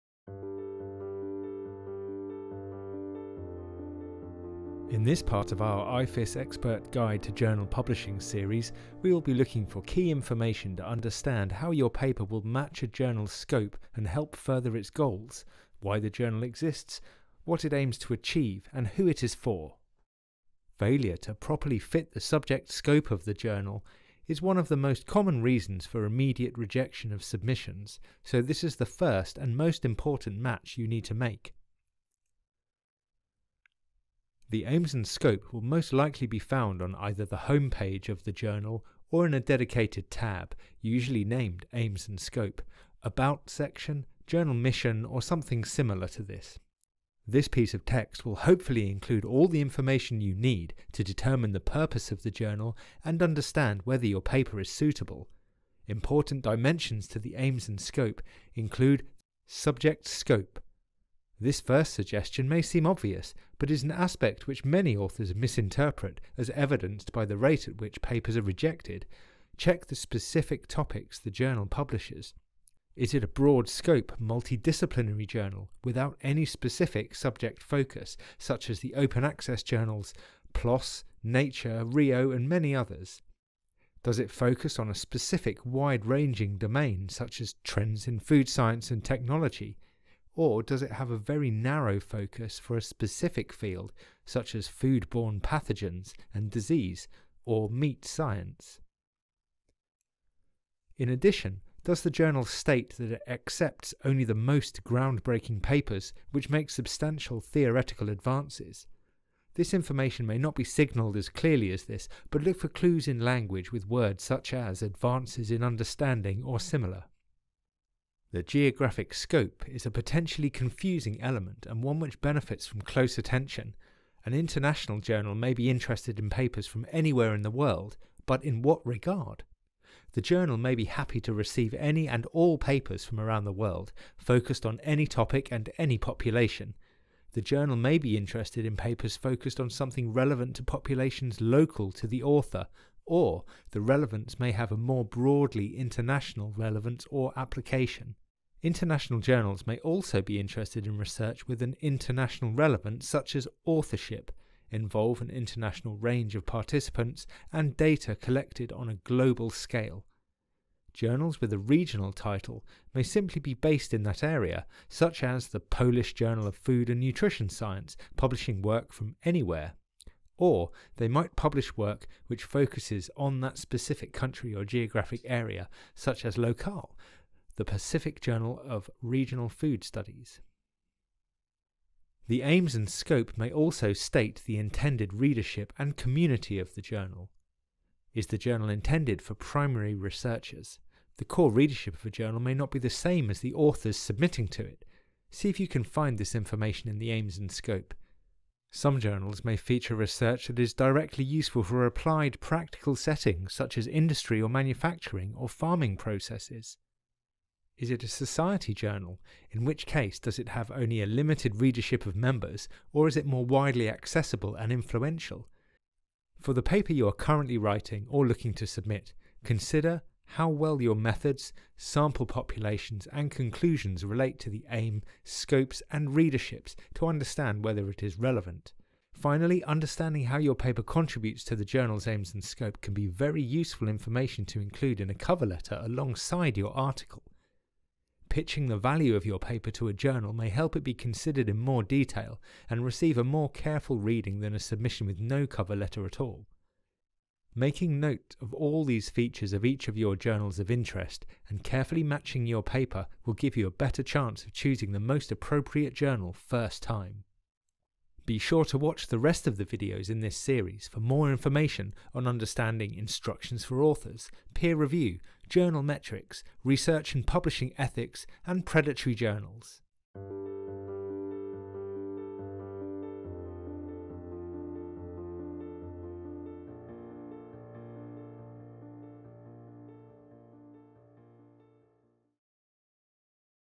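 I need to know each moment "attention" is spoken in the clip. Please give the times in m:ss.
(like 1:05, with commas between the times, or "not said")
2:03.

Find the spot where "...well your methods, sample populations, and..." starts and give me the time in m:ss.
3:40.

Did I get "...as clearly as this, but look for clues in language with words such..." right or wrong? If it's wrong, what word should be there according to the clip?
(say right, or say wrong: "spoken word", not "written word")
right.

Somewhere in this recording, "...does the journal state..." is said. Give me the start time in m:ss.
1:41.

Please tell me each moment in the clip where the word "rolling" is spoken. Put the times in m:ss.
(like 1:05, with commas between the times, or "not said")
not said.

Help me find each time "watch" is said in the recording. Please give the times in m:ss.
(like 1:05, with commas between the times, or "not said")
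4:18.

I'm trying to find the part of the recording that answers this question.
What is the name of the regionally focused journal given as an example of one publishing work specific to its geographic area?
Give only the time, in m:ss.
2:56.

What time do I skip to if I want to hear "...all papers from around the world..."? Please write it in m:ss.
2:12.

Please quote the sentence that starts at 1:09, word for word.
Check the specific topics the journal publishes.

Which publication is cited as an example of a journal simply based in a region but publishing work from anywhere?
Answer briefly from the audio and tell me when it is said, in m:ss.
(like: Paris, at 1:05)
Polish Journal of Food and Nutrition Science, at 2:45.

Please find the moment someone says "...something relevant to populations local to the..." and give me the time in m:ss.
2:19.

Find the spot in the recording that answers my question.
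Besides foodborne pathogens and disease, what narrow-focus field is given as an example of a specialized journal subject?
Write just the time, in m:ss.
1:37.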